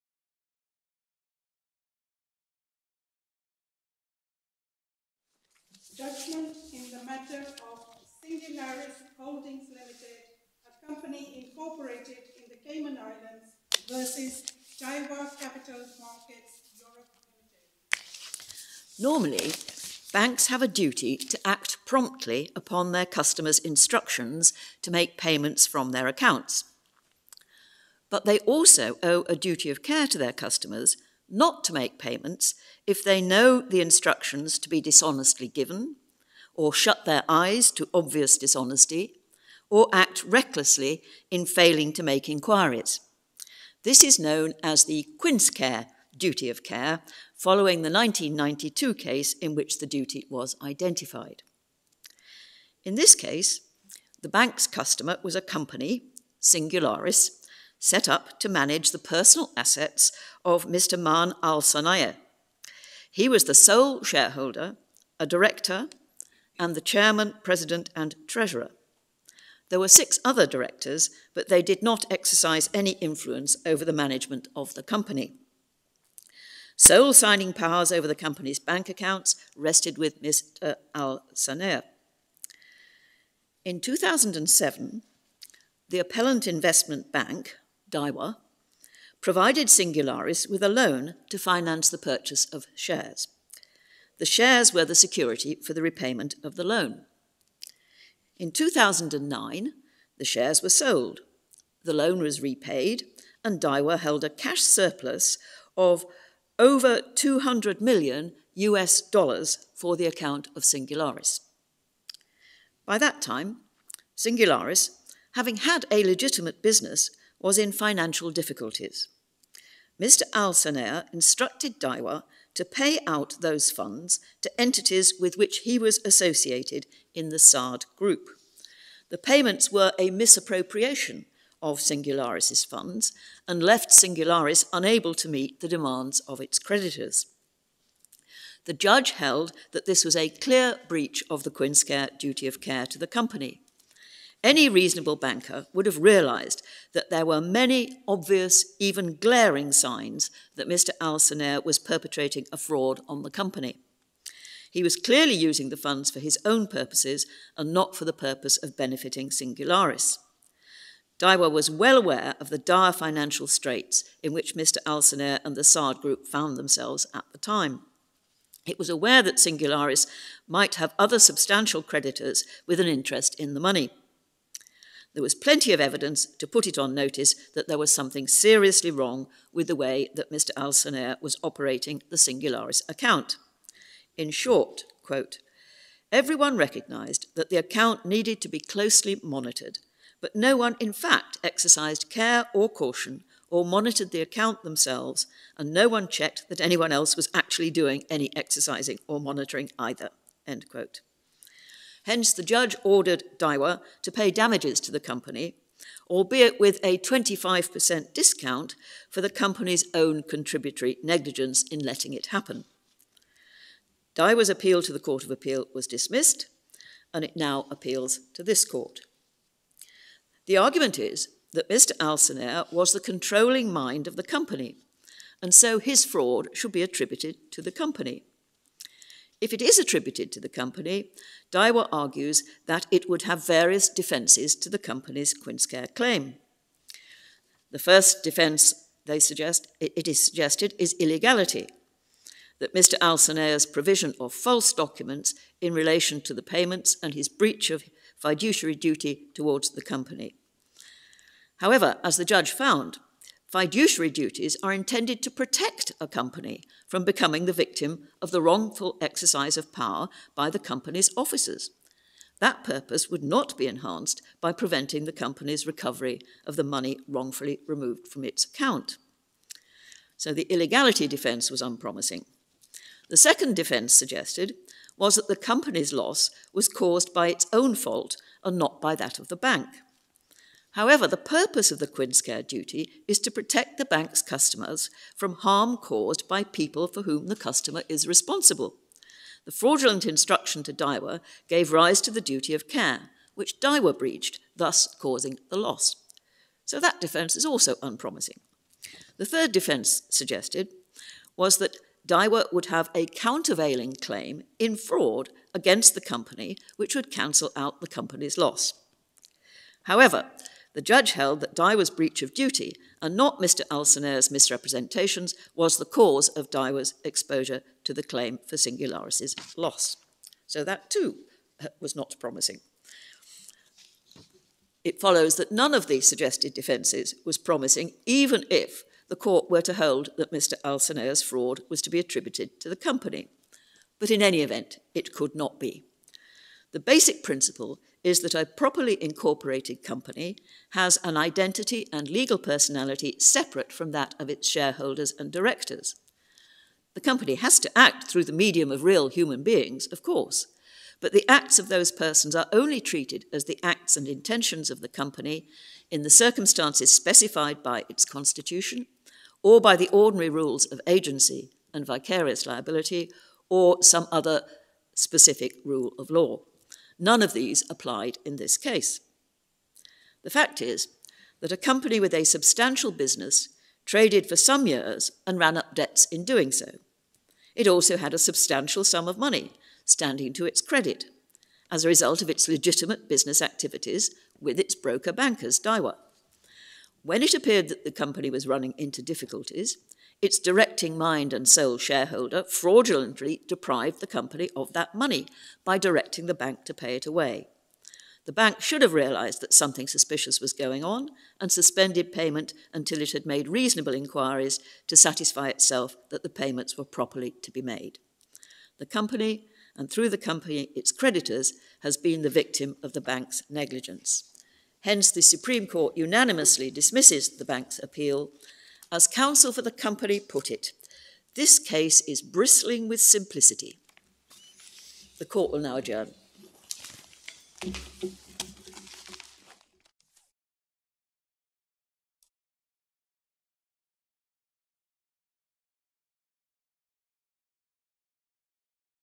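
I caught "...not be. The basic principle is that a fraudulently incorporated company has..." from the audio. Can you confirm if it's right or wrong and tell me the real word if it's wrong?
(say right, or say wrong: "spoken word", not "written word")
wrong: "properly", not "fraudulently".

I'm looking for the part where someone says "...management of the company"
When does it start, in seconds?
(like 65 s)
73 s.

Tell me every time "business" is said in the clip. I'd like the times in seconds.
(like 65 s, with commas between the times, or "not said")
116 s, 372 s, 383 s.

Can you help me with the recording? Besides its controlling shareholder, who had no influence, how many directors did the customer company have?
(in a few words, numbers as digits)
6.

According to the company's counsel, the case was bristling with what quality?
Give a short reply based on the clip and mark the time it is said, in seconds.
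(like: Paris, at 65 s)
Simplicity, at 422 s.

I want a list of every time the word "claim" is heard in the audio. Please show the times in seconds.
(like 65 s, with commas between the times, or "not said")
235 s, 304 s, 318 s.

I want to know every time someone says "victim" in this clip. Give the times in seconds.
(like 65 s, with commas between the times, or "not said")
257 s, 412 s.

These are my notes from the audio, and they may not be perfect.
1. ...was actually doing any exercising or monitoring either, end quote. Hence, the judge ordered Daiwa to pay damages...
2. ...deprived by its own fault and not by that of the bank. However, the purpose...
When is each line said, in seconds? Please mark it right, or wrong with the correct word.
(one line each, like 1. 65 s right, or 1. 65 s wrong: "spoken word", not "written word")
1. 197 s right
2. 276 s wrong: "caused", not "deprived".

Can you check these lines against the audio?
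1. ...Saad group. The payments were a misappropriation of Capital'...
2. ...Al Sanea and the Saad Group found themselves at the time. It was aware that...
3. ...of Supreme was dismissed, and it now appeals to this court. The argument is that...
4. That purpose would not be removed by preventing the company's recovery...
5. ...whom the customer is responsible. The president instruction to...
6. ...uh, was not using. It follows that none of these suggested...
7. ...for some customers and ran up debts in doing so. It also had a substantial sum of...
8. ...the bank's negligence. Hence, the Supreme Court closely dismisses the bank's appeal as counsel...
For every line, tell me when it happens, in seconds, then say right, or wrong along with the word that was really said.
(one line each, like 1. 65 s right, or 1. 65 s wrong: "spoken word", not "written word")
1. 127 s wrong: "Singularis", not "Capital"
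2. 164 s right
3. 215 s wrong: "Appeal", not "Supreme"
4. 262 s wrong: "enhanced", not "removed"
5. 287 s wrong: "fraudulent", not "president"
6. 321 s wrong: "promising", not "using"
7. 374 s wrong: "years", not "customers"
8. 412 s wrong: "unanimously", not "closely".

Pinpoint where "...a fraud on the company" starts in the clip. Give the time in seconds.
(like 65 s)
152 s.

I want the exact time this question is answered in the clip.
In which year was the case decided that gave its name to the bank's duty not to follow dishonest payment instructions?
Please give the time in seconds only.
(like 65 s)
47 s.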